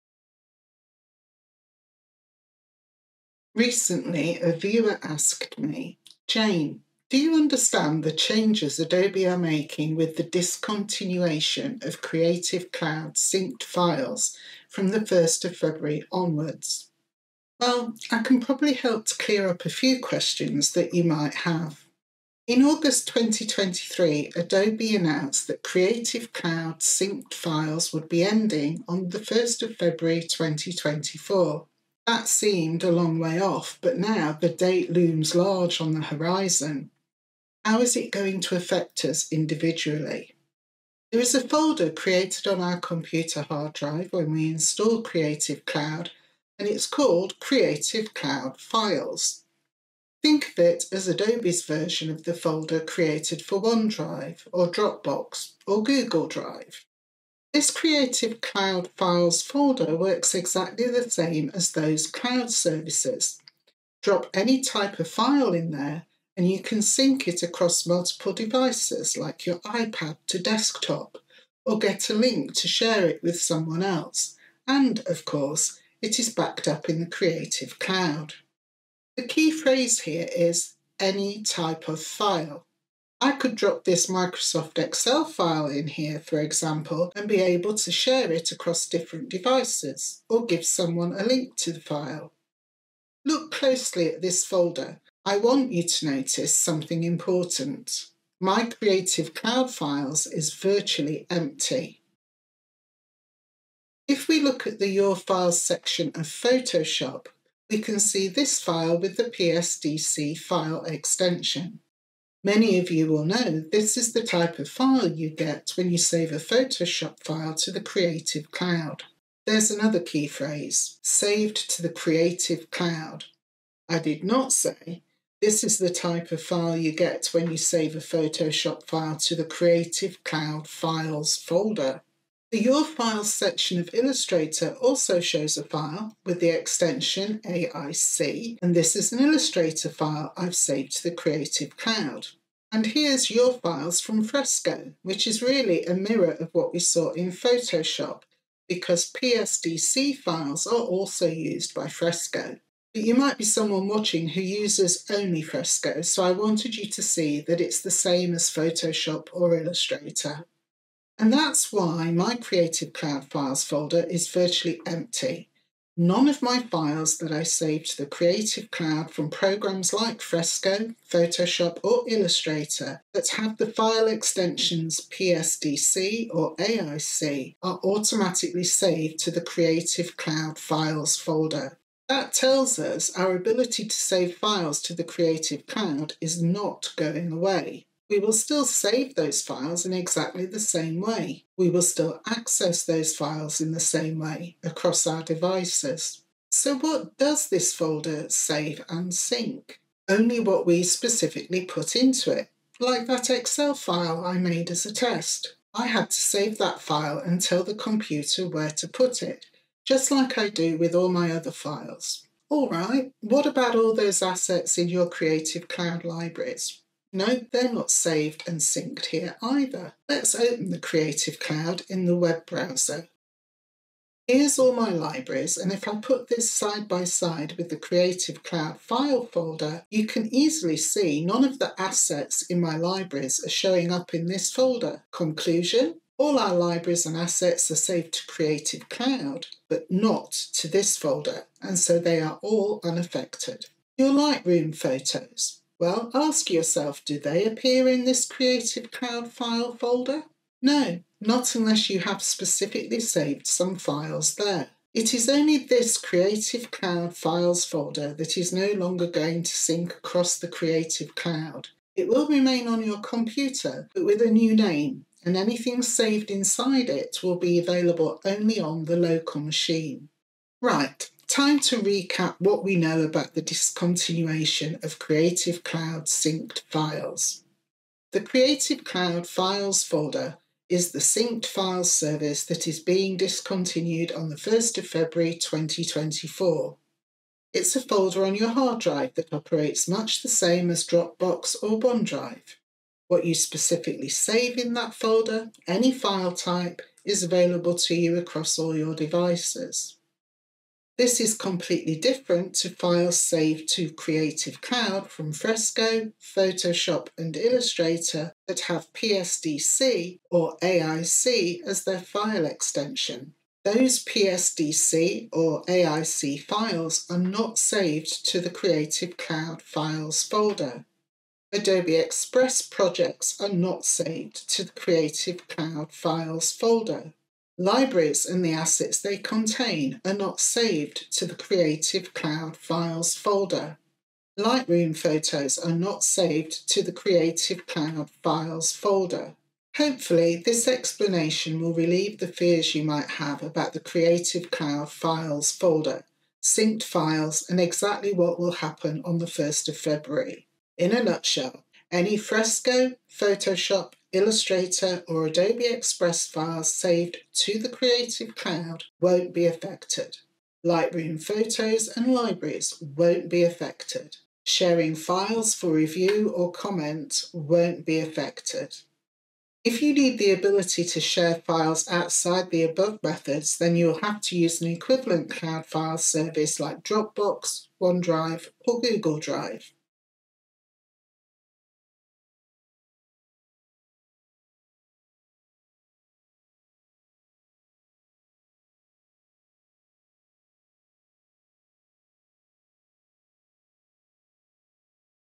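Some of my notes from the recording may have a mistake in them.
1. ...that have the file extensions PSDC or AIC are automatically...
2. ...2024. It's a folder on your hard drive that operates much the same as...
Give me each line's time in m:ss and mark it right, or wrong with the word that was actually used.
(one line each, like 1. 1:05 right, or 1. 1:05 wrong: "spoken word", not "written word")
1. 2:53 right
2. 4:45 right.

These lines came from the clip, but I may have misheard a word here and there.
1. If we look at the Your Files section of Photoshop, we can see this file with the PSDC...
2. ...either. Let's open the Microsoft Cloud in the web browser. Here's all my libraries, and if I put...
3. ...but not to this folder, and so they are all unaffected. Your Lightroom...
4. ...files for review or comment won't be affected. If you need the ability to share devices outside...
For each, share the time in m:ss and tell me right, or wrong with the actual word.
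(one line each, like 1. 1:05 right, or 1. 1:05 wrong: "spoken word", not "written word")
1. 1:44 right
2. 3:39 wrong: "Creative", not "Microsoft"
3. 3:59 right
4. 6:04 wrong: "files", not "devices".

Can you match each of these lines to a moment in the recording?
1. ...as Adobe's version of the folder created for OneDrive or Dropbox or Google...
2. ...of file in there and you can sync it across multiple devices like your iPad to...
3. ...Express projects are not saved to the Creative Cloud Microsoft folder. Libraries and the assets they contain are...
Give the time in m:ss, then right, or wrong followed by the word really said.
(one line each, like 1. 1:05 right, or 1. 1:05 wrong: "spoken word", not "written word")
1. 0:50 right
2. 1:05 right
3. 5:21 wrong: "Files", not "Microsoft".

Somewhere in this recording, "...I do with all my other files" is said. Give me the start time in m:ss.
3:30.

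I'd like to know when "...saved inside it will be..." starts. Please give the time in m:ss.
4:25.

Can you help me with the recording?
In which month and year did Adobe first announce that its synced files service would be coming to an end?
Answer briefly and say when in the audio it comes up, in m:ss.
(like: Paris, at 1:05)
August 2023, at 0:22.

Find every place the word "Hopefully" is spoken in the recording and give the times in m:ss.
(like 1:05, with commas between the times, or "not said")
5:39.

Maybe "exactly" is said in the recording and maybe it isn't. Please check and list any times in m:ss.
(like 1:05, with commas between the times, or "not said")
1:00, 3:09, 5:47.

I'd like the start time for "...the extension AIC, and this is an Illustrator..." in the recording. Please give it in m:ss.
2:16.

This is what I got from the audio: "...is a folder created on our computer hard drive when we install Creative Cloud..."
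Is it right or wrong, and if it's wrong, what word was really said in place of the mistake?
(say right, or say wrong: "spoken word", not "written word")
right.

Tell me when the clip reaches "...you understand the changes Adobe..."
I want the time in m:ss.
0:07.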